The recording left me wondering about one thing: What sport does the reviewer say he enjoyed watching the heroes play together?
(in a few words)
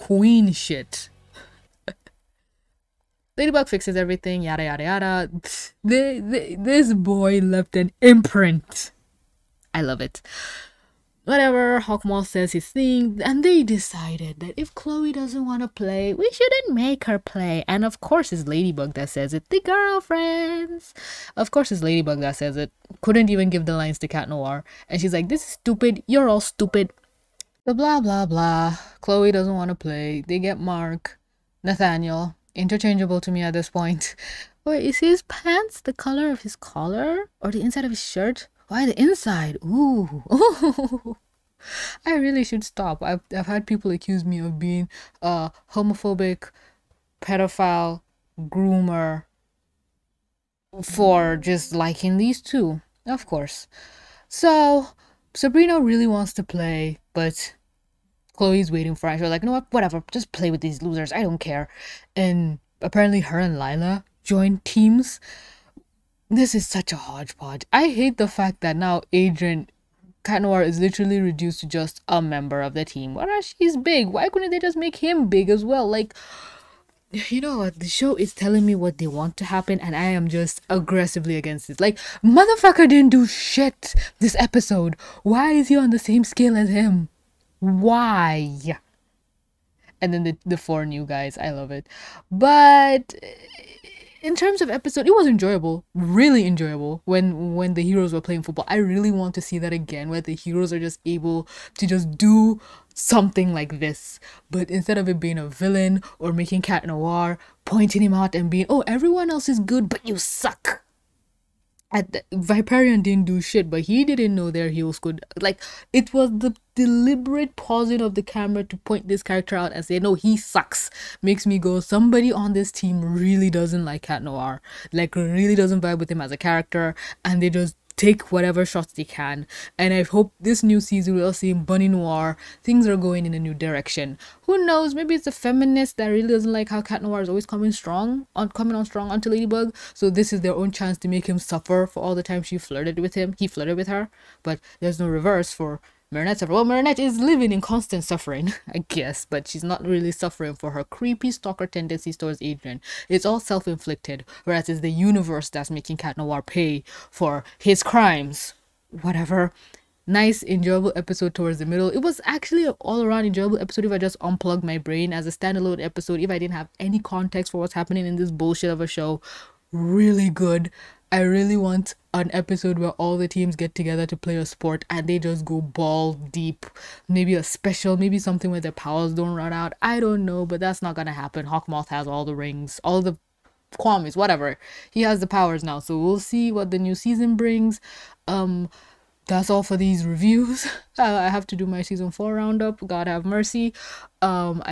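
Football.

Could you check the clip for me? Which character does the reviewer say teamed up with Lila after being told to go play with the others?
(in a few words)
Sabrina.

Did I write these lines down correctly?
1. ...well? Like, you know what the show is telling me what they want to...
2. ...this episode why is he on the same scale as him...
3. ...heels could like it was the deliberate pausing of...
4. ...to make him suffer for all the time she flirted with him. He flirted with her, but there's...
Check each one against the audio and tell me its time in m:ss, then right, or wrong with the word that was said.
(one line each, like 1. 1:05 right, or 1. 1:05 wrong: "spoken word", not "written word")
1. 1:15 right
2. 1:24 right
3. 1:54 right
4. 2:20 right.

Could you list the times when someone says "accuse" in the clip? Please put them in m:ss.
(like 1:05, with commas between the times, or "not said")
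0:43.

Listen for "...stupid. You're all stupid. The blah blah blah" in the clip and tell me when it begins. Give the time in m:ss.
0:25.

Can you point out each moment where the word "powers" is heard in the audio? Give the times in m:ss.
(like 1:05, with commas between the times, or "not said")
2:58, 3:05.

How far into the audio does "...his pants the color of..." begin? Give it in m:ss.
0:34.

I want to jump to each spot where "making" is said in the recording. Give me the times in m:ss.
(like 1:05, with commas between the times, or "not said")
1:46, 2:35.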